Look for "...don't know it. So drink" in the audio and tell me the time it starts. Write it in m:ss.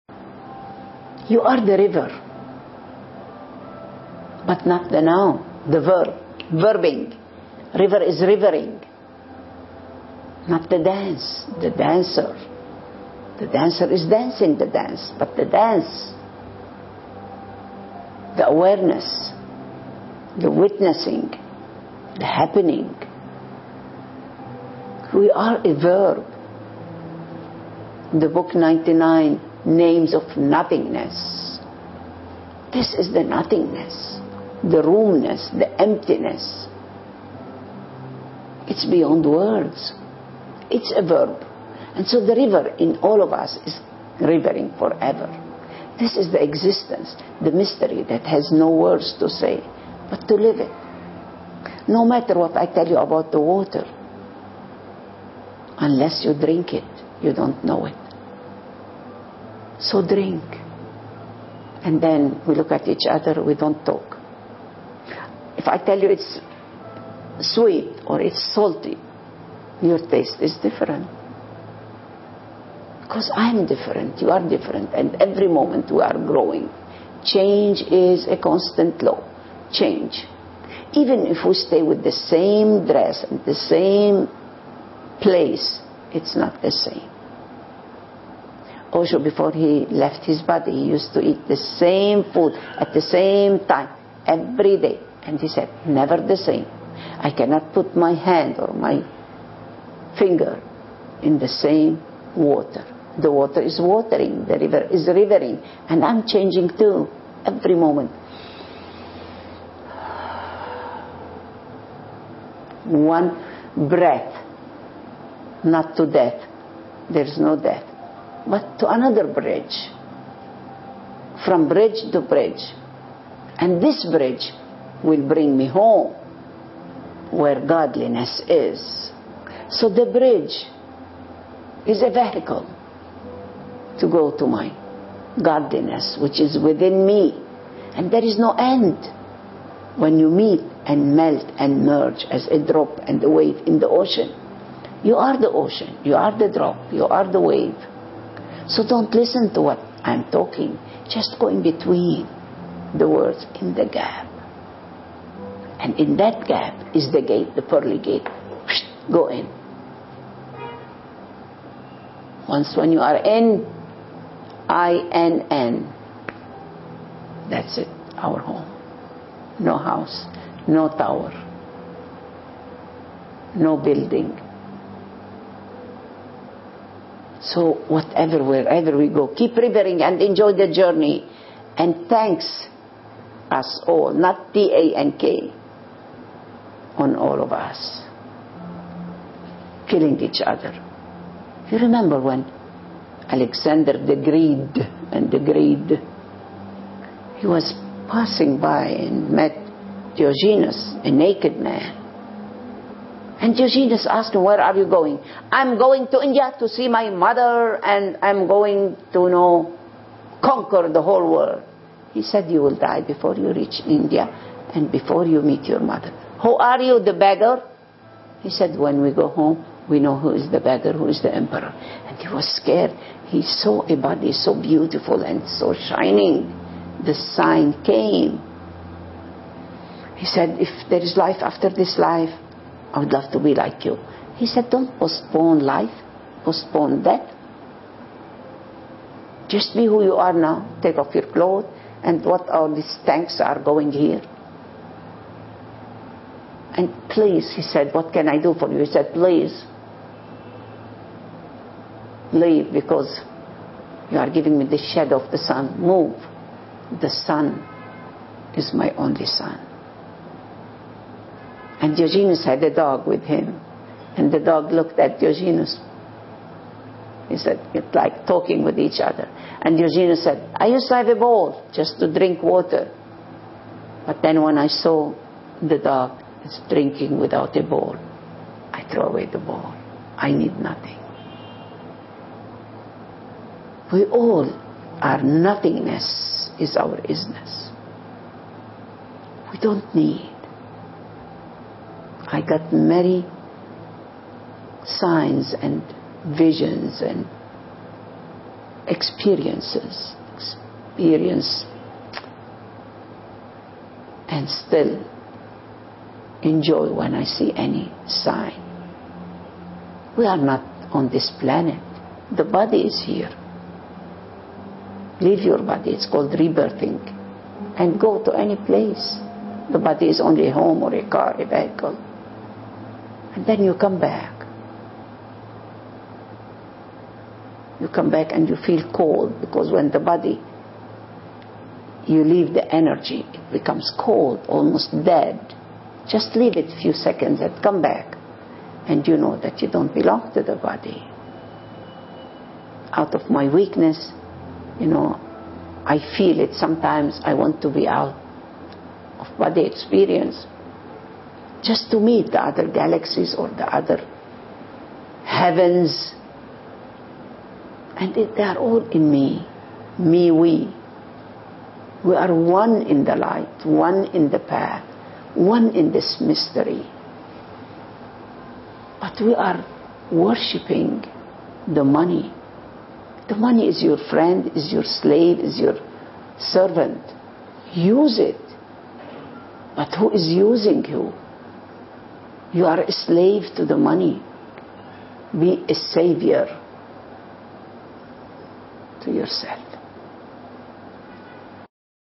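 0:57.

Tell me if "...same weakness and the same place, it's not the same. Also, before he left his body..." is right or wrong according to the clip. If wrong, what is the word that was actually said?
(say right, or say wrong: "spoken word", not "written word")
wrong: "dress", not "weakness".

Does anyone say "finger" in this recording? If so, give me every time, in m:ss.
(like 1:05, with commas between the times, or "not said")
1:40.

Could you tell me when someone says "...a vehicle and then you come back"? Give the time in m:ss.
5:21.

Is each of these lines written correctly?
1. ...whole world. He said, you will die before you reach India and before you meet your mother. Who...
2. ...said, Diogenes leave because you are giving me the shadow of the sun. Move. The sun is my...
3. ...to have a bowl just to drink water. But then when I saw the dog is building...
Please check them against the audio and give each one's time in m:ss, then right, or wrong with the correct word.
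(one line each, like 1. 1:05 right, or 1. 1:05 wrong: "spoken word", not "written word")
1. 3:31 right
2. 4:08 wrong: "Please", not "Diogenes"
3. 4:30 wrong: "drinking", not "building".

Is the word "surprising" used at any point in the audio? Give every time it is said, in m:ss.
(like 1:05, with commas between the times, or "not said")
not said.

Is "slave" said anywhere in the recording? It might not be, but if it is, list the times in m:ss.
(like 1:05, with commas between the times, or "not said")
6:14, 6:22.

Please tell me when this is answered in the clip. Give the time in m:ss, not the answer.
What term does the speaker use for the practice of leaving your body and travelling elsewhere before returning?
5:16.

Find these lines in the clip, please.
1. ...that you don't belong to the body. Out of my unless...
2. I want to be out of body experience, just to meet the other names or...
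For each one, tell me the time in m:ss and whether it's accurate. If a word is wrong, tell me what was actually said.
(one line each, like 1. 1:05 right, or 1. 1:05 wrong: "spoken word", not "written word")
1. 5:39 wrong: "weakness", not "unless"
2. 5:47 wrong: "galaxies", not "names".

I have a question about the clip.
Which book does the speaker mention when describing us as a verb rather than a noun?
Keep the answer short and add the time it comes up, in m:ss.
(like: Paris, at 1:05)
99 Names of Nothingness, at 0:28.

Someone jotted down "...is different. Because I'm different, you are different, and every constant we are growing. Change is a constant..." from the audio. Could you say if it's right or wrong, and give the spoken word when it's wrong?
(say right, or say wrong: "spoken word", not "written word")
wrong: "moment", not "constant".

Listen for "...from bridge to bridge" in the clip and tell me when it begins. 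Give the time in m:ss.
2:01.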